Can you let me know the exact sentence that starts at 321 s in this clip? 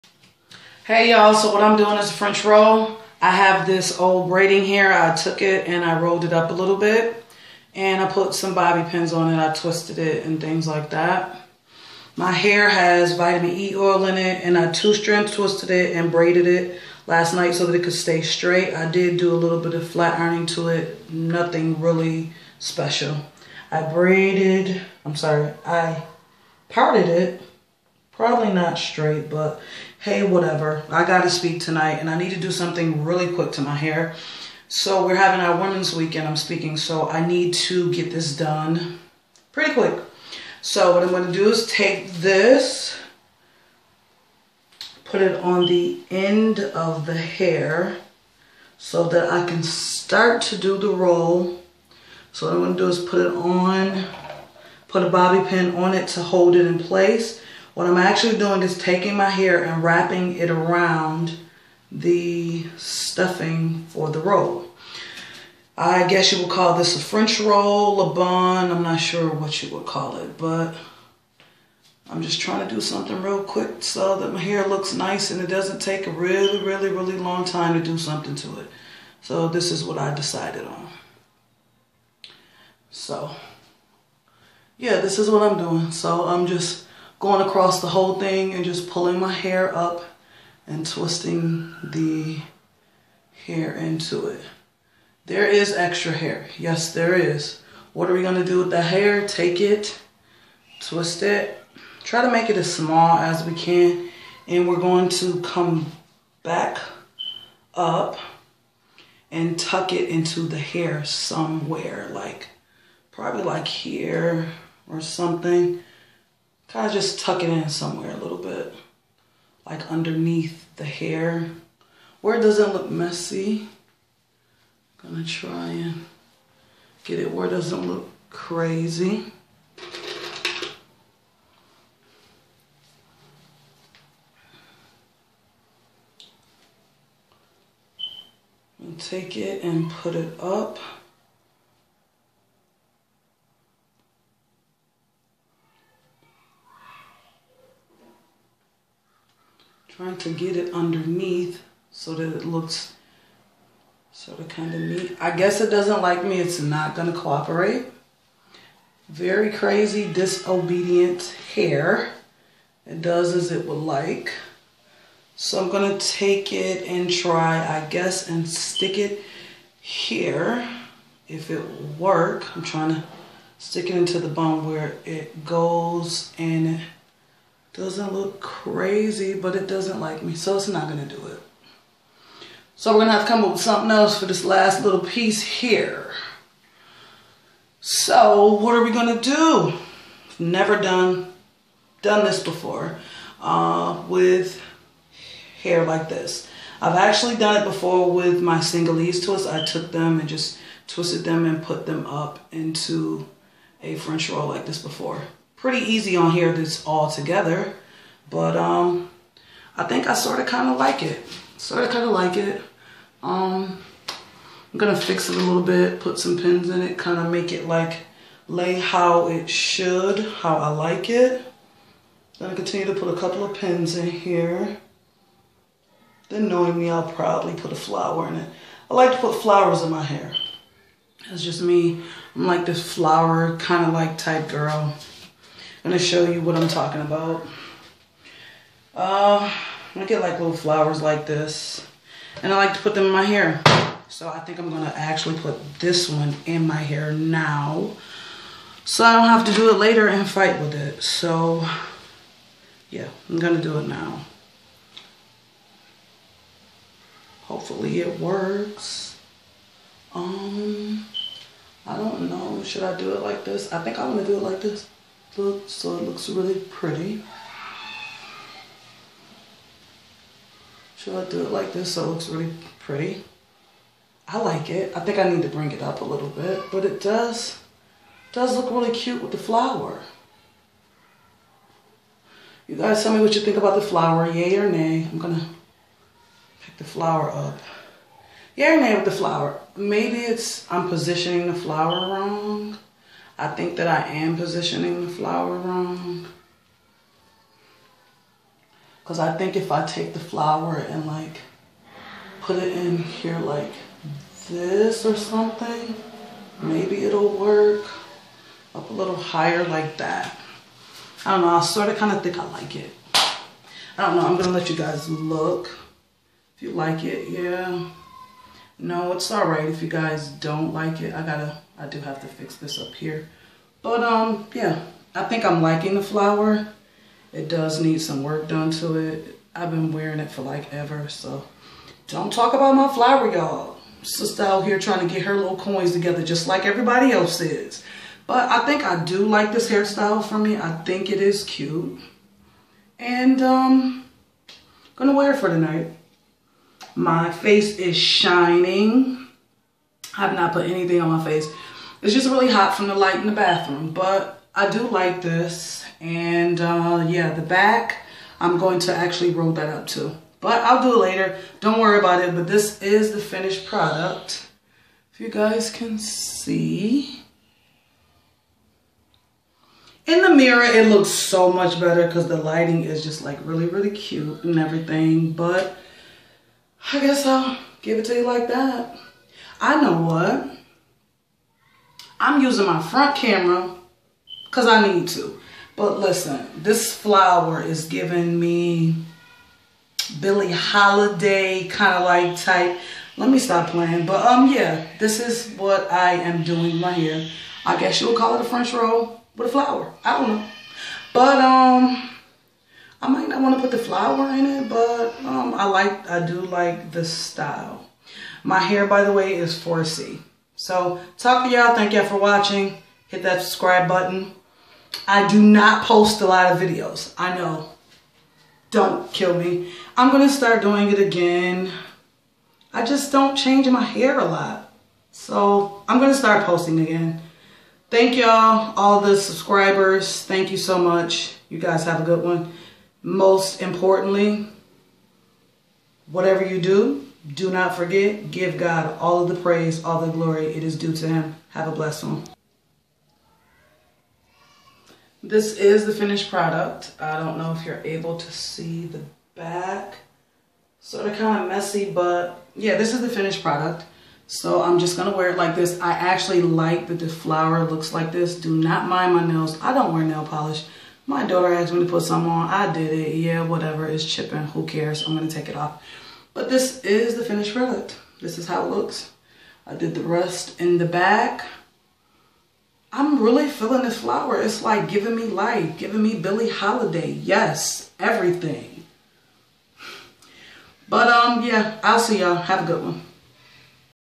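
I gotta I do have to fix this up here.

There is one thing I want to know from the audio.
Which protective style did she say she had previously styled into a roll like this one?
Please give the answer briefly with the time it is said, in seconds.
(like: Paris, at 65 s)
Senegalese twists, at 198 s.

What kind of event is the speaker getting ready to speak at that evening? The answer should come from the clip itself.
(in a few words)
Women's weekend.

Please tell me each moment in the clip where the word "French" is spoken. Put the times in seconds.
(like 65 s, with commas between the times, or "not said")
2 s, 67 s, 203 s, 398 s.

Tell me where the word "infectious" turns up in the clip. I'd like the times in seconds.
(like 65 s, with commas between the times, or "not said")
not said.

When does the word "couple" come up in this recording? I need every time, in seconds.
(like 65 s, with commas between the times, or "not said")
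223 s.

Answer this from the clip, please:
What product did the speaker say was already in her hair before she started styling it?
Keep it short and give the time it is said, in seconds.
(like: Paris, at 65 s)
Vitamin E oil, at 13 s.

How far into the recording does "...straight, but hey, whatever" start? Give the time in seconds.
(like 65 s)
28 s.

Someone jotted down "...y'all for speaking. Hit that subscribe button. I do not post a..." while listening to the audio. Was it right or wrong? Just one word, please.
wrong.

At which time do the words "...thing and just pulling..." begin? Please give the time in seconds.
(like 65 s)
88 s.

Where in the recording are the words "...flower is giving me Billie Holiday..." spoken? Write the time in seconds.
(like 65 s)
386 s.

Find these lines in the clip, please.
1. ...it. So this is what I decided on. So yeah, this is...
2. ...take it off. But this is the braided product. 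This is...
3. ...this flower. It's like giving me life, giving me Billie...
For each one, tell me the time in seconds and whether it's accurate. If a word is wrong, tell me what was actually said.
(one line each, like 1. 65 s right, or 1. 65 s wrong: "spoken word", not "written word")
1. 78 s right
2. 465 s wrong: "finished", not "braided"
3. 473 s right.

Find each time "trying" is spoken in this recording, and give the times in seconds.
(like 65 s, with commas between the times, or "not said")
72 s, 150 s, 172 s, 334 s.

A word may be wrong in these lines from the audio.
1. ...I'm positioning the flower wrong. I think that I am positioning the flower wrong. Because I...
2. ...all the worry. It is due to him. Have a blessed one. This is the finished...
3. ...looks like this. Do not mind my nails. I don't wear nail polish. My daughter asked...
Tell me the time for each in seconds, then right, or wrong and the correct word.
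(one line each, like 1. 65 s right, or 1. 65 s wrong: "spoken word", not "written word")
1. 290 s right
2. 439 s wrong: "glory", not "worry"
3. 457 s right.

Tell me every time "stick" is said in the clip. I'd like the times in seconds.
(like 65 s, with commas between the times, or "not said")
168 s, 173 s.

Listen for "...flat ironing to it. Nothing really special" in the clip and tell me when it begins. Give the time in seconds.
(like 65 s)
19 s.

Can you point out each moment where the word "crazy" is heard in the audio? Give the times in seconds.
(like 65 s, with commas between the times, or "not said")
128 s, 159 s, 178 s.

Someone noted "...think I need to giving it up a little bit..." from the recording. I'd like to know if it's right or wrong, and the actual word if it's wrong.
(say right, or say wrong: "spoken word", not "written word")
wrong: "bring", not "giving".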